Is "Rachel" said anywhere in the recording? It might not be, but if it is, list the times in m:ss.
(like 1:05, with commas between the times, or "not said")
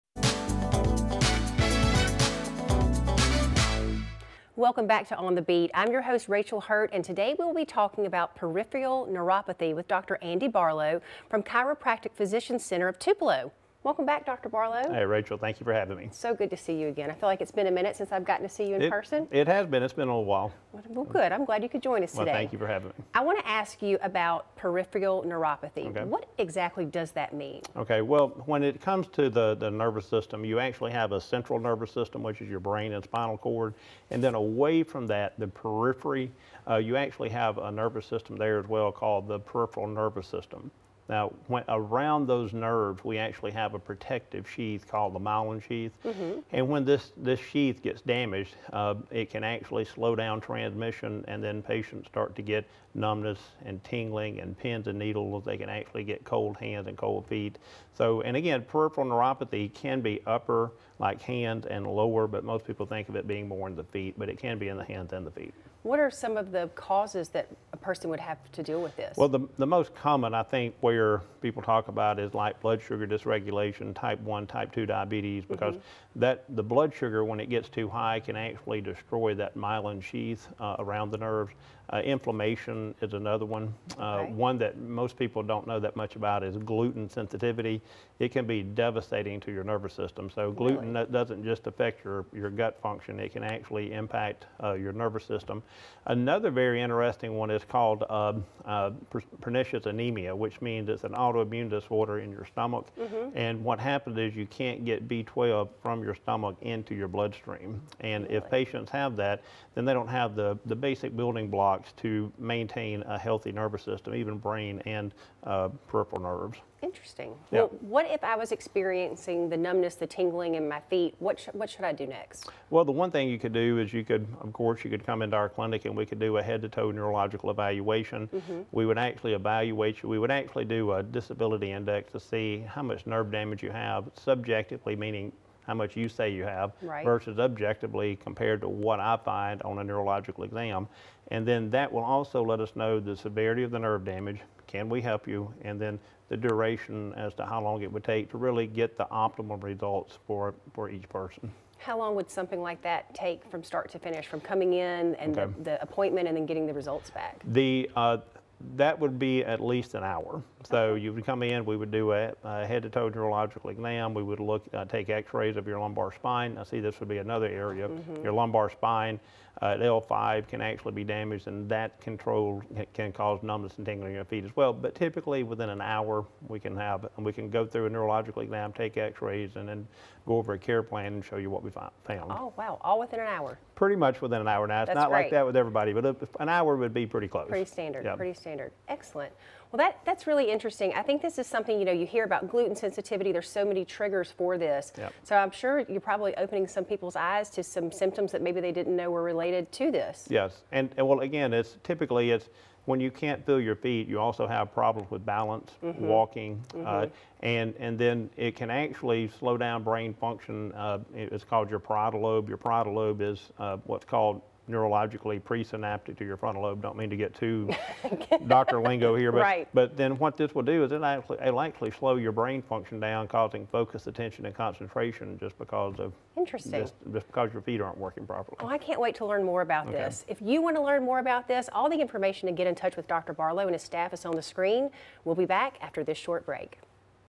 0:06, 0:15.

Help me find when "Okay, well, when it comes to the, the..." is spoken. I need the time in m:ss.
0:27.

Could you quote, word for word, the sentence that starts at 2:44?
We would look, uh, take X-rays of your lumbar spine.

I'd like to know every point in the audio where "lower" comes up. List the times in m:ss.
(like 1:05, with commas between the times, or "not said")
1:01.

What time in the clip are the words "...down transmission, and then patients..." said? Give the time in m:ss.
0:50.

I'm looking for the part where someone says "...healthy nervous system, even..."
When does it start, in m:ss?
1:53.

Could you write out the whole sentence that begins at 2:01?
What, sh- what should I do next?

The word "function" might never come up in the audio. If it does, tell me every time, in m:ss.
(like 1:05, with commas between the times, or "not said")
1:32, 3:30, 3:42.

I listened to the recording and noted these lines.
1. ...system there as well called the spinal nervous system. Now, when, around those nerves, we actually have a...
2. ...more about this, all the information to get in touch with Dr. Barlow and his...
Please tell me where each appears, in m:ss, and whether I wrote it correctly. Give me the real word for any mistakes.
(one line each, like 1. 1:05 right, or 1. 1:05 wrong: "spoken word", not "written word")
1. 0:38 wrong: "peripheral", not "spinal"
2. 3:51 right.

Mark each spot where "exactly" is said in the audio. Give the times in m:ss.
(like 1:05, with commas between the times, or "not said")
0:26.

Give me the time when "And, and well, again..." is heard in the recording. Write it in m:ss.
3:20.